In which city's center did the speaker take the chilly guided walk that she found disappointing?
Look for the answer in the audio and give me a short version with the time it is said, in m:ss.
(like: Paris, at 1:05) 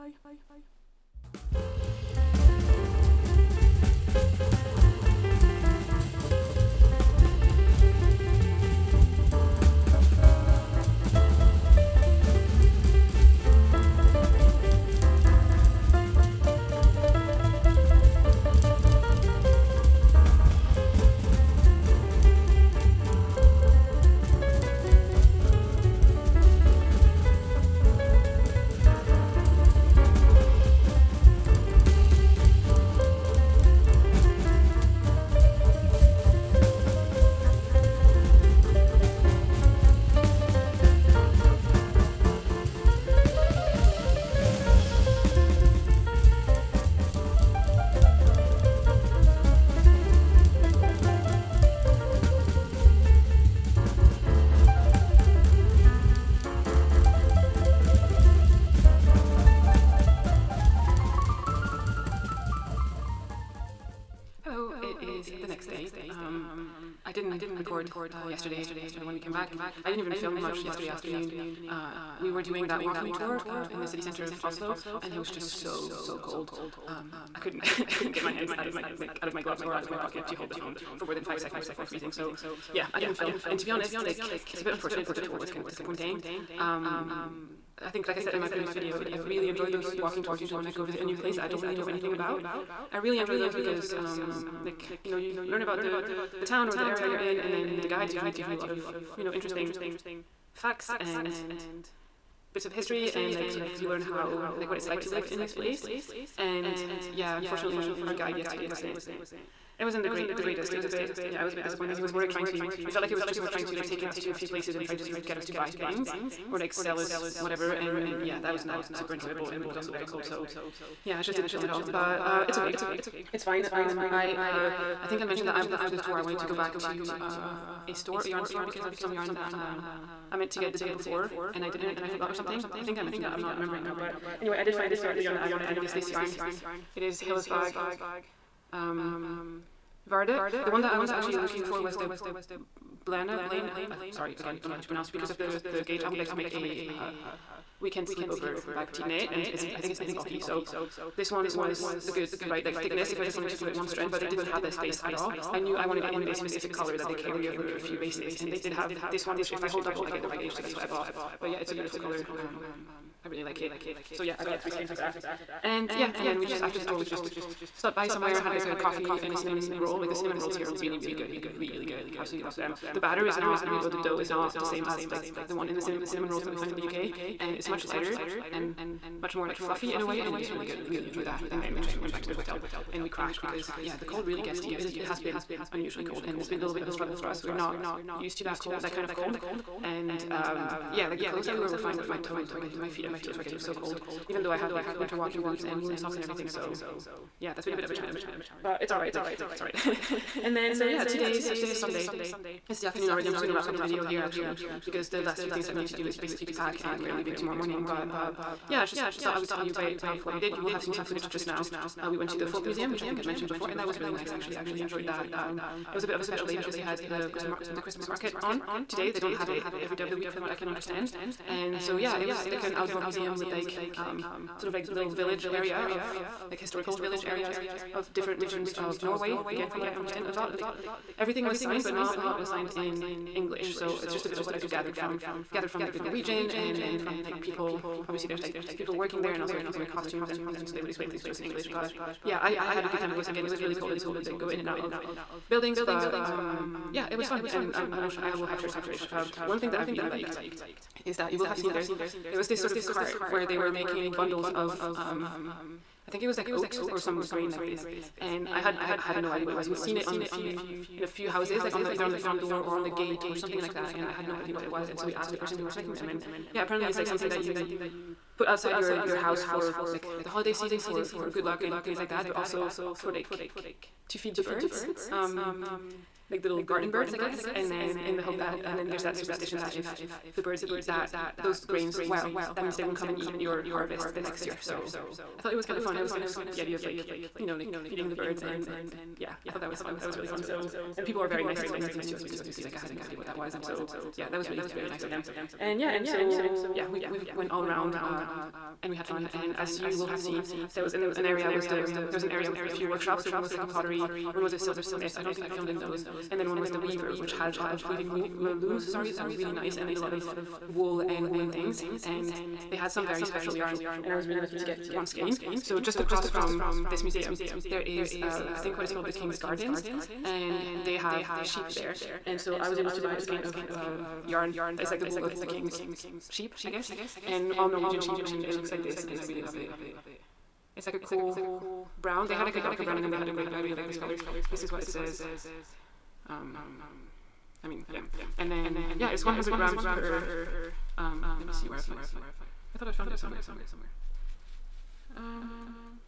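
Oslo, at 1:14.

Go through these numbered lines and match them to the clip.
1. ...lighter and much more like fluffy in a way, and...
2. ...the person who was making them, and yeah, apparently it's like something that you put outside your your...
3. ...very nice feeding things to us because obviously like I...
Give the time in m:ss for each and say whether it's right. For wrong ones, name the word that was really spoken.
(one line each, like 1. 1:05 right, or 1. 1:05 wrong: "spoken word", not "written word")
1. 2:57 right
2. 4:25 right
3. 4:51 wrong: "explaining", not "feeding".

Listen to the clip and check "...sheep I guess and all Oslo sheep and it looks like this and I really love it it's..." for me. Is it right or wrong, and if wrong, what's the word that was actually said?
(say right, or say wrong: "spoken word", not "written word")
wrong: "Norwegian", not "Oslo".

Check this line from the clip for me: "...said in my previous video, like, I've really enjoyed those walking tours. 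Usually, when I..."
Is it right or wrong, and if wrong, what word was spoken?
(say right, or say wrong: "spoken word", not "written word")
right.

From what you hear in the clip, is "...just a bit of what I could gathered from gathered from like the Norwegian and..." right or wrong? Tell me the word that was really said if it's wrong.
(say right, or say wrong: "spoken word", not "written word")
right.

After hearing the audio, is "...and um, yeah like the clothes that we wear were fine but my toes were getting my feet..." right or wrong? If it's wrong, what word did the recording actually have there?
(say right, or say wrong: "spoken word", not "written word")
right.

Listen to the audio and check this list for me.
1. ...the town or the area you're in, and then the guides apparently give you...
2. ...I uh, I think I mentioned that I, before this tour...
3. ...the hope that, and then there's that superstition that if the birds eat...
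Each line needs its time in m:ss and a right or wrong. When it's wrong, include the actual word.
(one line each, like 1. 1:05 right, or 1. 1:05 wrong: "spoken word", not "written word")
1. 1:36 wrong: "usually", not "apparently"
2. 2:04 right
3. 4:38 right.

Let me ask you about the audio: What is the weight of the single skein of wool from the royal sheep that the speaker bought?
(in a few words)
100 grams.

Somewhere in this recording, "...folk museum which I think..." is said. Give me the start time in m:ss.
3:32.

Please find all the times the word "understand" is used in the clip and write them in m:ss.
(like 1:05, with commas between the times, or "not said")
3:40, 3:49.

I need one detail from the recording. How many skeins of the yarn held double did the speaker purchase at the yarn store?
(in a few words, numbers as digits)
3.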